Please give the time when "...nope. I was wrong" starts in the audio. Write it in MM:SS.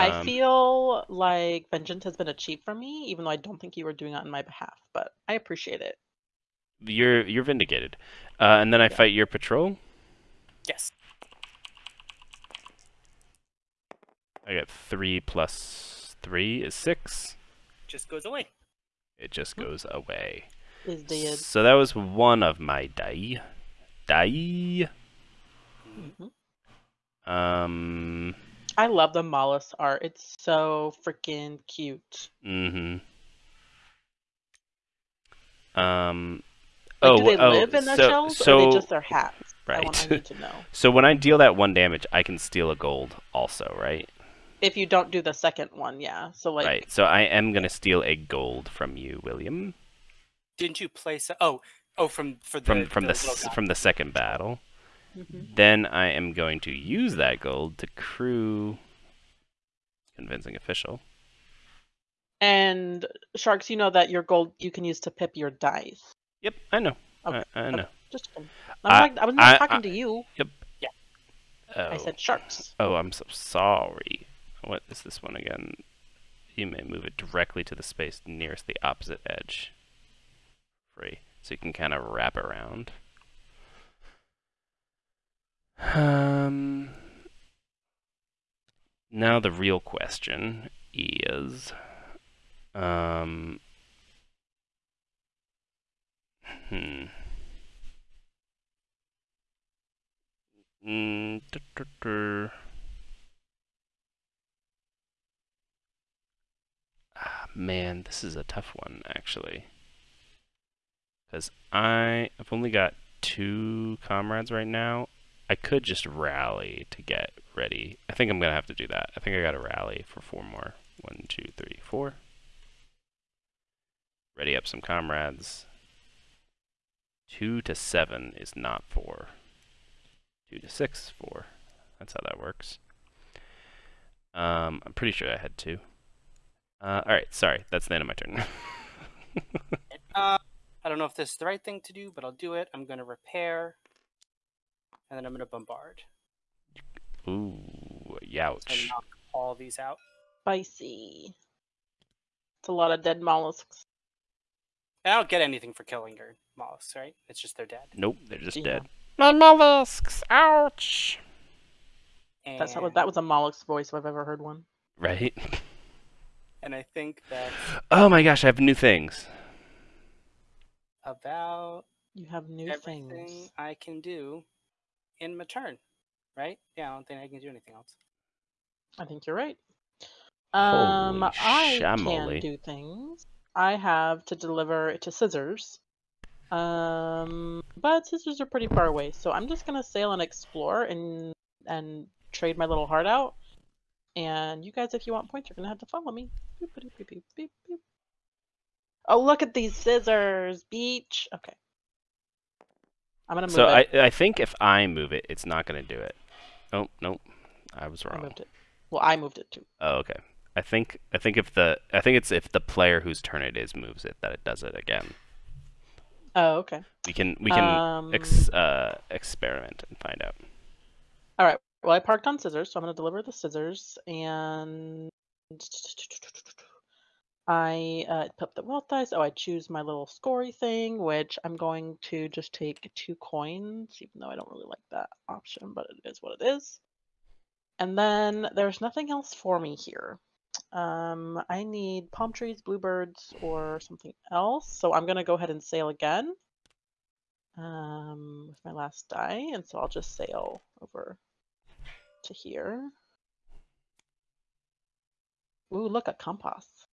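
03:26.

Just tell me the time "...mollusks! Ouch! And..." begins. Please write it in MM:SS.
02:39.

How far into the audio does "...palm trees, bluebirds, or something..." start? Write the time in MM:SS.
04:02.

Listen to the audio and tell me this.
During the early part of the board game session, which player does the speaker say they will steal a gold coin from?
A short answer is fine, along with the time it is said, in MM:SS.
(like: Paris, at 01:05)
William, at 00:49.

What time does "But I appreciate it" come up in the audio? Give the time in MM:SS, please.
00:04.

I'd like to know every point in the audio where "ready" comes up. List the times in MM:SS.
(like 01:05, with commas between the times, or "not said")
01:57, 02:04.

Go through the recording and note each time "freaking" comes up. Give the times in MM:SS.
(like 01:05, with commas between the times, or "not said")
00:31.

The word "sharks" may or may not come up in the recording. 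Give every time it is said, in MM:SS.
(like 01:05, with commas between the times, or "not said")
01:03, 01:12.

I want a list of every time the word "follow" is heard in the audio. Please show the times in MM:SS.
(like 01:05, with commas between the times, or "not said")
03:15.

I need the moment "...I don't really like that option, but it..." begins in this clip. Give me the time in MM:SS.
03:54.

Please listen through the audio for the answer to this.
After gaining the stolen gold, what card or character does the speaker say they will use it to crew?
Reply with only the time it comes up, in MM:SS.
01:00.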